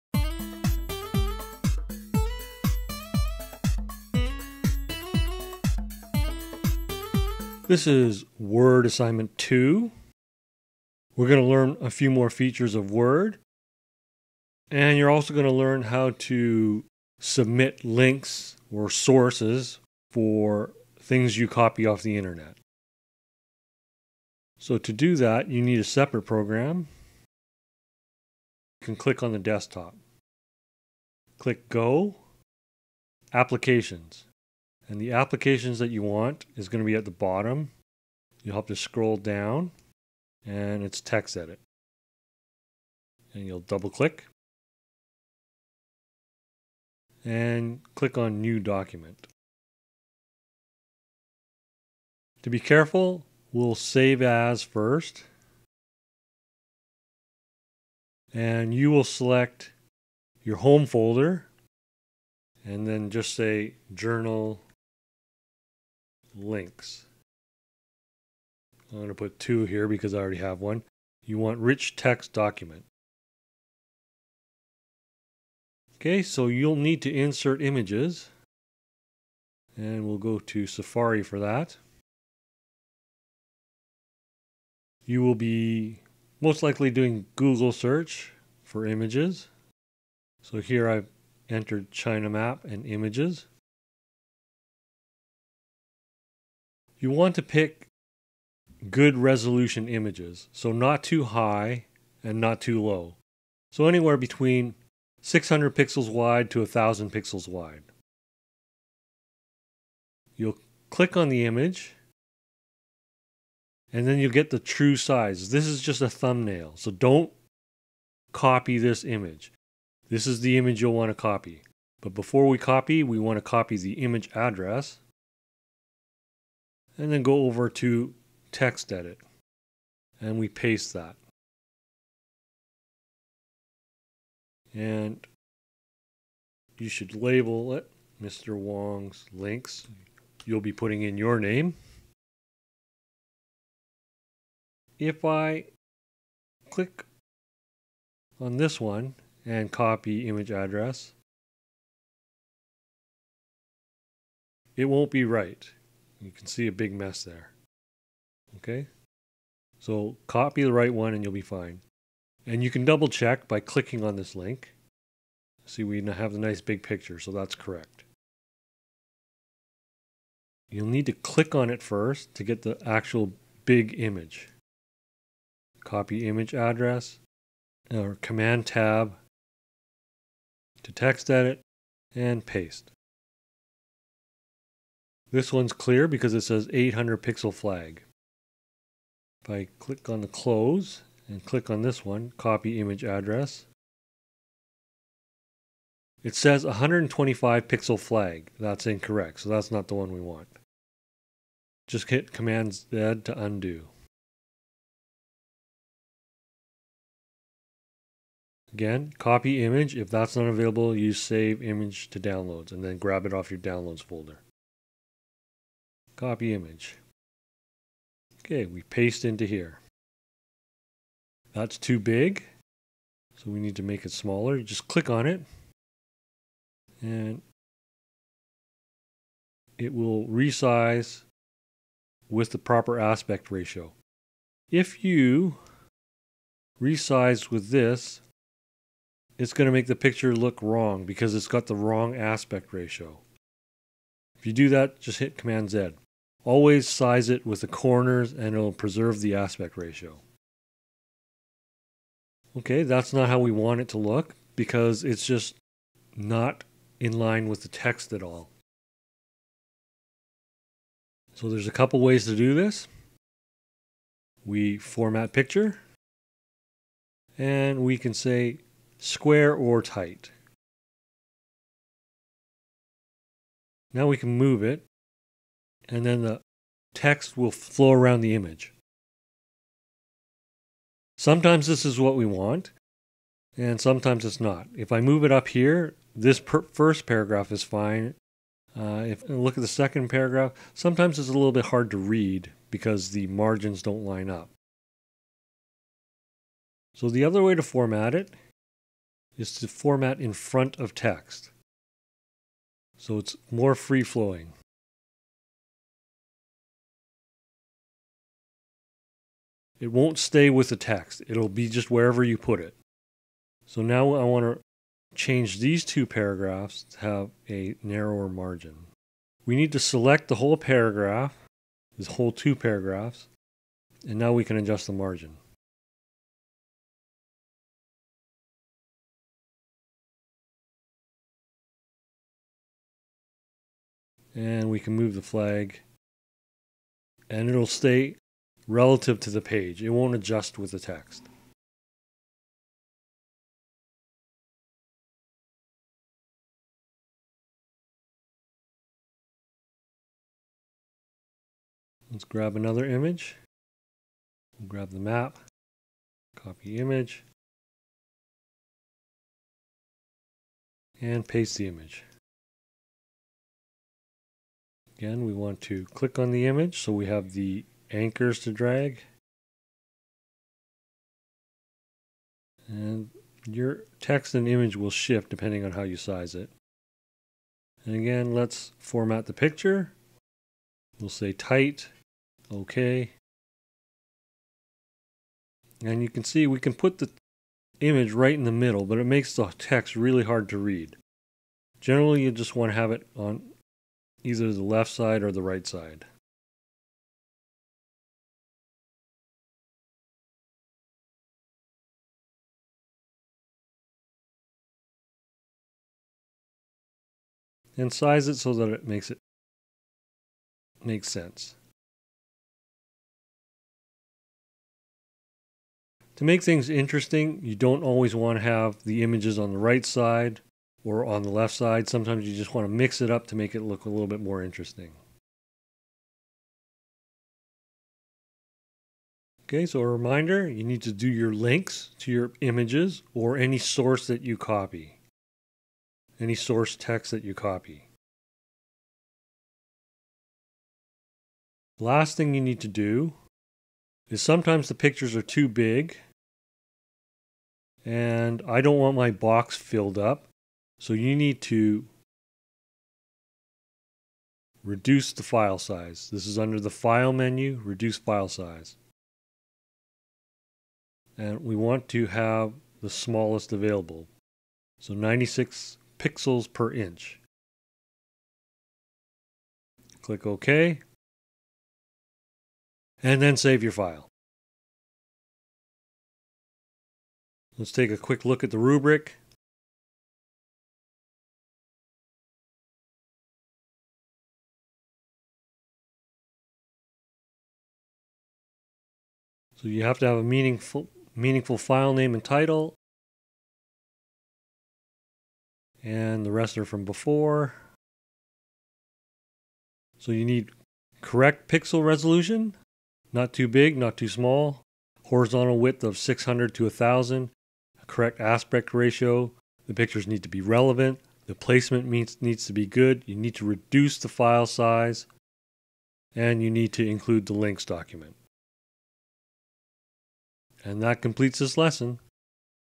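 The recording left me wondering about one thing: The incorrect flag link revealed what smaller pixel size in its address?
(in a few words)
125 pixel.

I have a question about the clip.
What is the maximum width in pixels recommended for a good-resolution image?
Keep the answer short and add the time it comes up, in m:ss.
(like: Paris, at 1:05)
1000 pixels, at 1:46.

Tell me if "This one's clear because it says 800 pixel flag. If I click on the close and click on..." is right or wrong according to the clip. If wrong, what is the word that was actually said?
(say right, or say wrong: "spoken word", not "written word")
right.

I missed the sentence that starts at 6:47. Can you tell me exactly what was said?
and size it so that it makes it makes sense.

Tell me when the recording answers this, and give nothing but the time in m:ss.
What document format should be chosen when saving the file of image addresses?
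1:11.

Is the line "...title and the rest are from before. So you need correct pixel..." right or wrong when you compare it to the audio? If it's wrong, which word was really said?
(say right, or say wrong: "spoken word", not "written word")
right.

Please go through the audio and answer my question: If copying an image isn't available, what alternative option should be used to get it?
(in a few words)
save image to downloads.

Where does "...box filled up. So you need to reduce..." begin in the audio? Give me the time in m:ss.
7:29.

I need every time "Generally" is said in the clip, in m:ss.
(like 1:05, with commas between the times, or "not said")
6:31.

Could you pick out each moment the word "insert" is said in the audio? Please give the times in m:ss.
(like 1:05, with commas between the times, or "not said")
1:17.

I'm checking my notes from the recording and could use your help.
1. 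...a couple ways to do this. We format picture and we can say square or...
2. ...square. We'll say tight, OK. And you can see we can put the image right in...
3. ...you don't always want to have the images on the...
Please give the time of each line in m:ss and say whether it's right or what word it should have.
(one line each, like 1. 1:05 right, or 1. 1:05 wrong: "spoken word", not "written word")
1. 4:21 right
2. 6:19 wrong: "picture", not "square"
3. 6:57 right.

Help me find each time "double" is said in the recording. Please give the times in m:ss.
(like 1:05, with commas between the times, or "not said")
0:43, 2:42.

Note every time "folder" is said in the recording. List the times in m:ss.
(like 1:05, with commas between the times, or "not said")
1:00, 3:34.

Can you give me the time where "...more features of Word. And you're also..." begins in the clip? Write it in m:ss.
0:12.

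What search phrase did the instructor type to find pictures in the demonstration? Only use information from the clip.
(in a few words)
China map.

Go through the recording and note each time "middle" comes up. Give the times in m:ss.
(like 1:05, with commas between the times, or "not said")
6:28.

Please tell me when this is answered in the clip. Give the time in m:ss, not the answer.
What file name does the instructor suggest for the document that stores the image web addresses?
1:03.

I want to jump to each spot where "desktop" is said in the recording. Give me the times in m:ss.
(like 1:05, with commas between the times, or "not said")
0:29.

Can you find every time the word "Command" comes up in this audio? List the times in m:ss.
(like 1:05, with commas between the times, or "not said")
2:58, 3:22, 4:05.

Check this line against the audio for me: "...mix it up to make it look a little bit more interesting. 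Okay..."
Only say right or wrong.
right.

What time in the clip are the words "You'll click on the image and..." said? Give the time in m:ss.
1:50.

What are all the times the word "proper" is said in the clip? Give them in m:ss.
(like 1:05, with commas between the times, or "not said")
3:52.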